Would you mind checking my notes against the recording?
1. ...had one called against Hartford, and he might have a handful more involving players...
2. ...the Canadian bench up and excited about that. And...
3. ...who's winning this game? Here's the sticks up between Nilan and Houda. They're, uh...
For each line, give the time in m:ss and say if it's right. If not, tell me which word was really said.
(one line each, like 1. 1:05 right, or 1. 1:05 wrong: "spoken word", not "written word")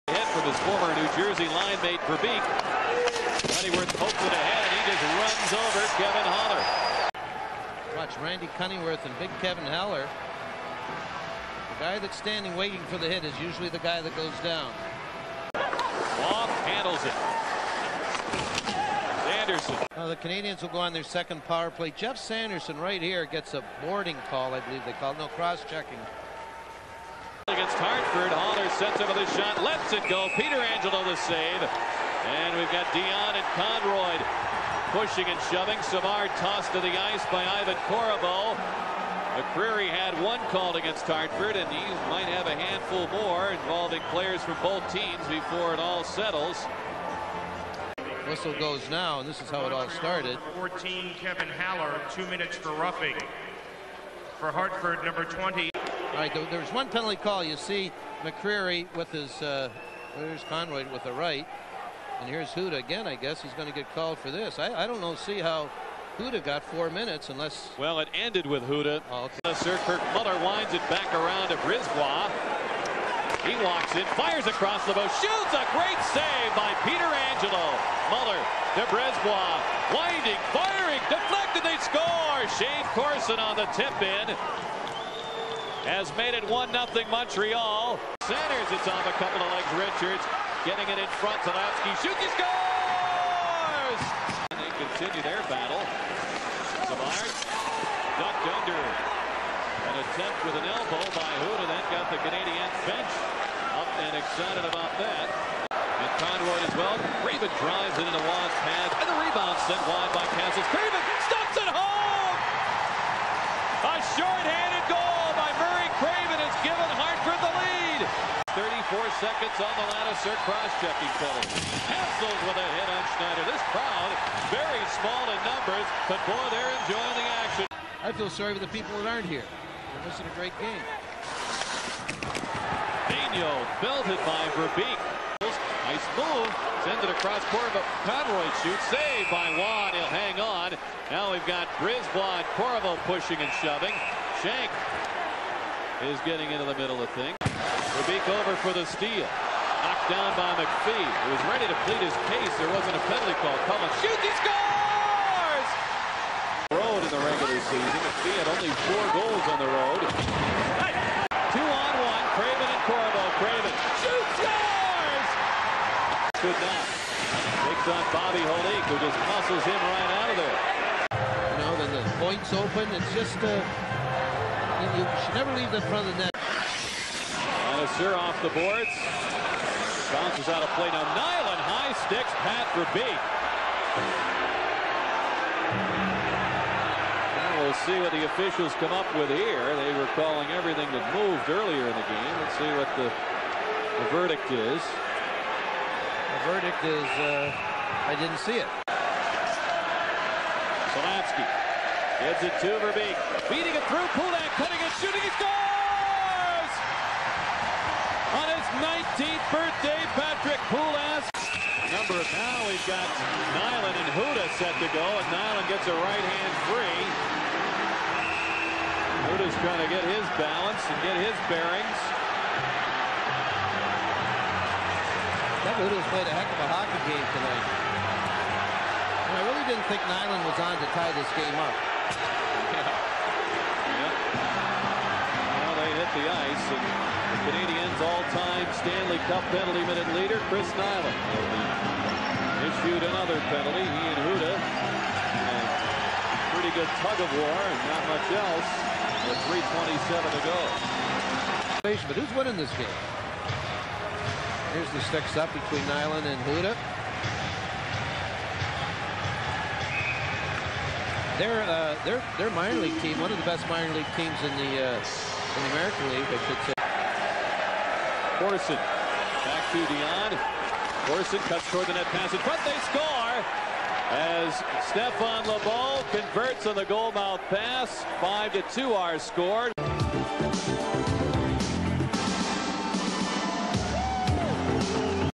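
1. 0:39 right
2. 1:42 right
3. 4:12 right.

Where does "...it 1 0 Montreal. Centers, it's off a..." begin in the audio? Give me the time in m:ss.
1:26.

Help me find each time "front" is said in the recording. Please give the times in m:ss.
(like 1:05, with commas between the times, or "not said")
1:31, 2:55.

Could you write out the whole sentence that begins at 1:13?
He walks in, fires across the boat shoots a great save by Pietrangelo.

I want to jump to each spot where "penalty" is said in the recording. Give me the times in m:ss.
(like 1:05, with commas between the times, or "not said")
0:56, 2:01, 2:33, 3:59, 4:03.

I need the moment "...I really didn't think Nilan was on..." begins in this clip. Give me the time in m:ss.
3:49.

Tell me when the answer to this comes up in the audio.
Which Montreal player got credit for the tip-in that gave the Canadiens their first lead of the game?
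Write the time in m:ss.
1:22.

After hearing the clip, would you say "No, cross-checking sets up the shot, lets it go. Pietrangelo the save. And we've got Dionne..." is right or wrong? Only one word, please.
right.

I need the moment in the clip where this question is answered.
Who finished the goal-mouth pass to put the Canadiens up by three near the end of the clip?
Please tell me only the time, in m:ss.
4:34.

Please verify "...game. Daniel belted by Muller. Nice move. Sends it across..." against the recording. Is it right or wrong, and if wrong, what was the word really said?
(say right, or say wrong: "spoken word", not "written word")
wrong: "Verbeek", not "Muller".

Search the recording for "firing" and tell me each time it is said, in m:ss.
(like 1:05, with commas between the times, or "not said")
1:20.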